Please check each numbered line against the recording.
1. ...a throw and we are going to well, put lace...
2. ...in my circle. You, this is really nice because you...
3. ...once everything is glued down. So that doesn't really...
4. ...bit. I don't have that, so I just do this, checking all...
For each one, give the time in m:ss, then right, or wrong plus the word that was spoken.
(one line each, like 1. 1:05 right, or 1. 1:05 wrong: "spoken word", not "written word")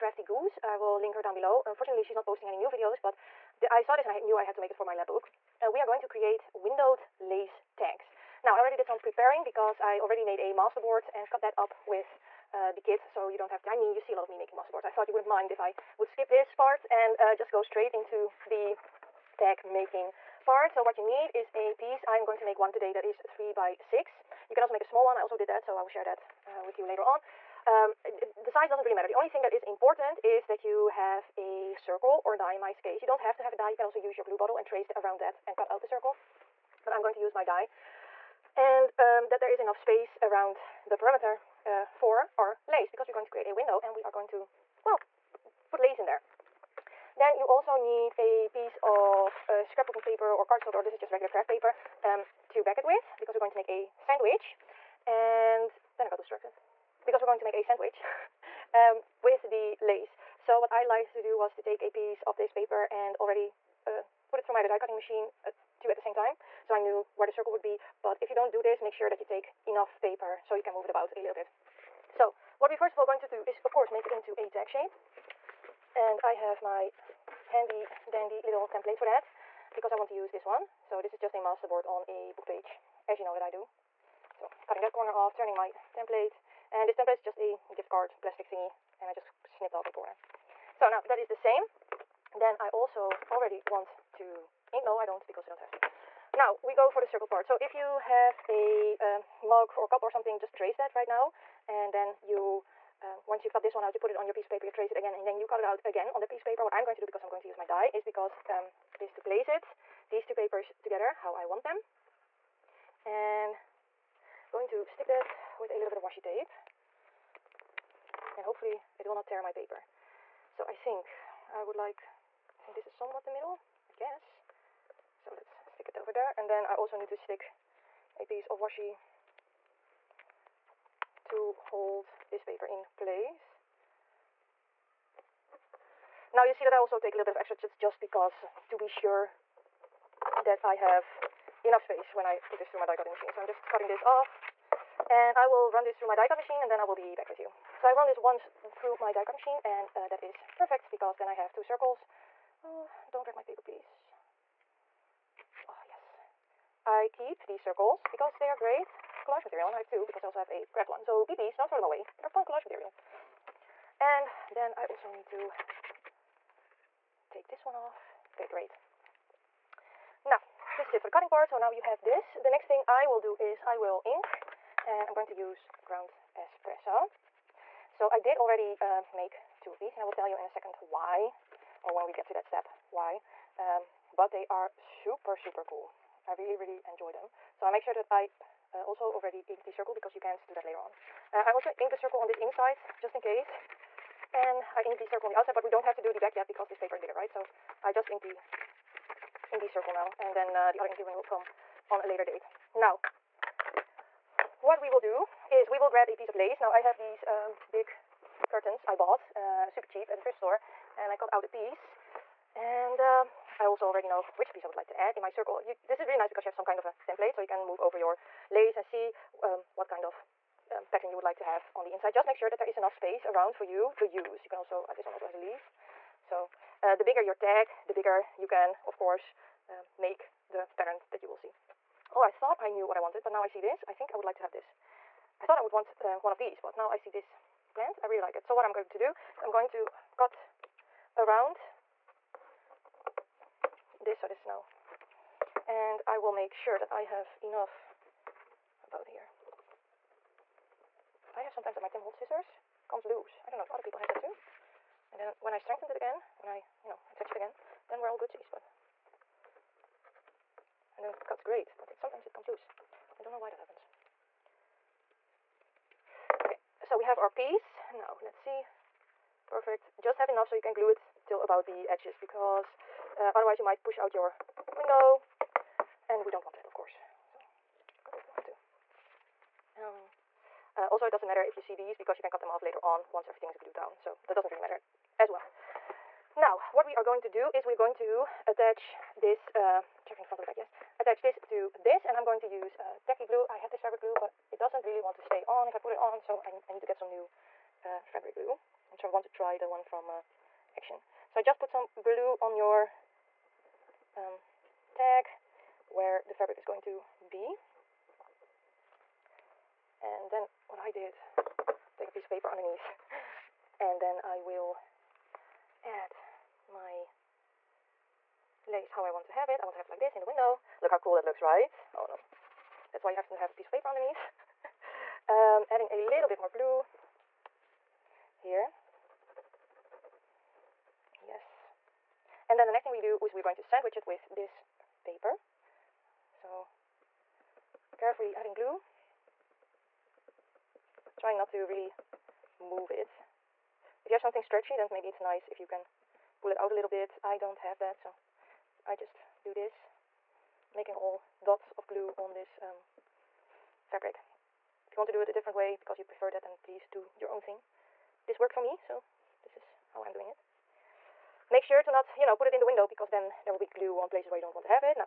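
1. 0:43 wrong: "window", not "throw"
2. 3:35 right
3. 4:43 right
4. 5:46 wrong: "making", not "checking".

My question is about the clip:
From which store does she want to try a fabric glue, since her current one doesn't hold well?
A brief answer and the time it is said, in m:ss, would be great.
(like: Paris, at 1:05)
Action, at 5:00.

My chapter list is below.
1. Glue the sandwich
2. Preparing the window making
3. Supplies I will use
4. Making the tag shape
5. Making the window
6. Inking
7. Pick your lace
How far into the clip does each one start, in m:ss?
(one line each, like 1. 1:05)
1. 4:50
2. 0:37
3. 0:08
4. 1:12
5. 1:38
6. 2:52
7. 3:24.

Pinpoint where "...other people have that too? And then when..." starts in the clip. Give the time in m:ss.
4:13.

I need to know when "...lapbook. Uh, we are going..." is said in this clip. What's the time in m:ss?
0:04.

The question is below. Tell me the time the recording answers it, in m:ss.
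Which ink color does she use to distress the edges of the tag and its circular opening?
2:55.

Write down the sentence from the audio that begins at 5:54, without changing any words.
If you want to do it a different way because you prefer that, then please do your own thing.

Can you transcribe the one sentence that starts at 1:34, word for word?
No, I don't, because I don't have to.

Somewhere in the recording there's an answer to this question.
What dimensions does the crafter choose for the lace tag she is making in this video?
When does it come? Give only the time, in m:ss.
0:23.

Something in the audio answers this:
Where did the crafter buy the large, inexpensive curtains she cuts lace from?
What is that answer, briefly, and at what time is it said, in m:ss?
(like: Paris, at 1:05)
A thrift store, at 3:30.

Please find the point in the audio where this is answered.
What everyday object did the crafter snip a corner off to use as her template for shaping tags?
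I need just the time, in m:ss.
1:27.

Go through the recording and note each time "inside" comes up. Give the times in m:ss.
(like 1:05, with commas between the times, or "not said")
3:12, 3:41.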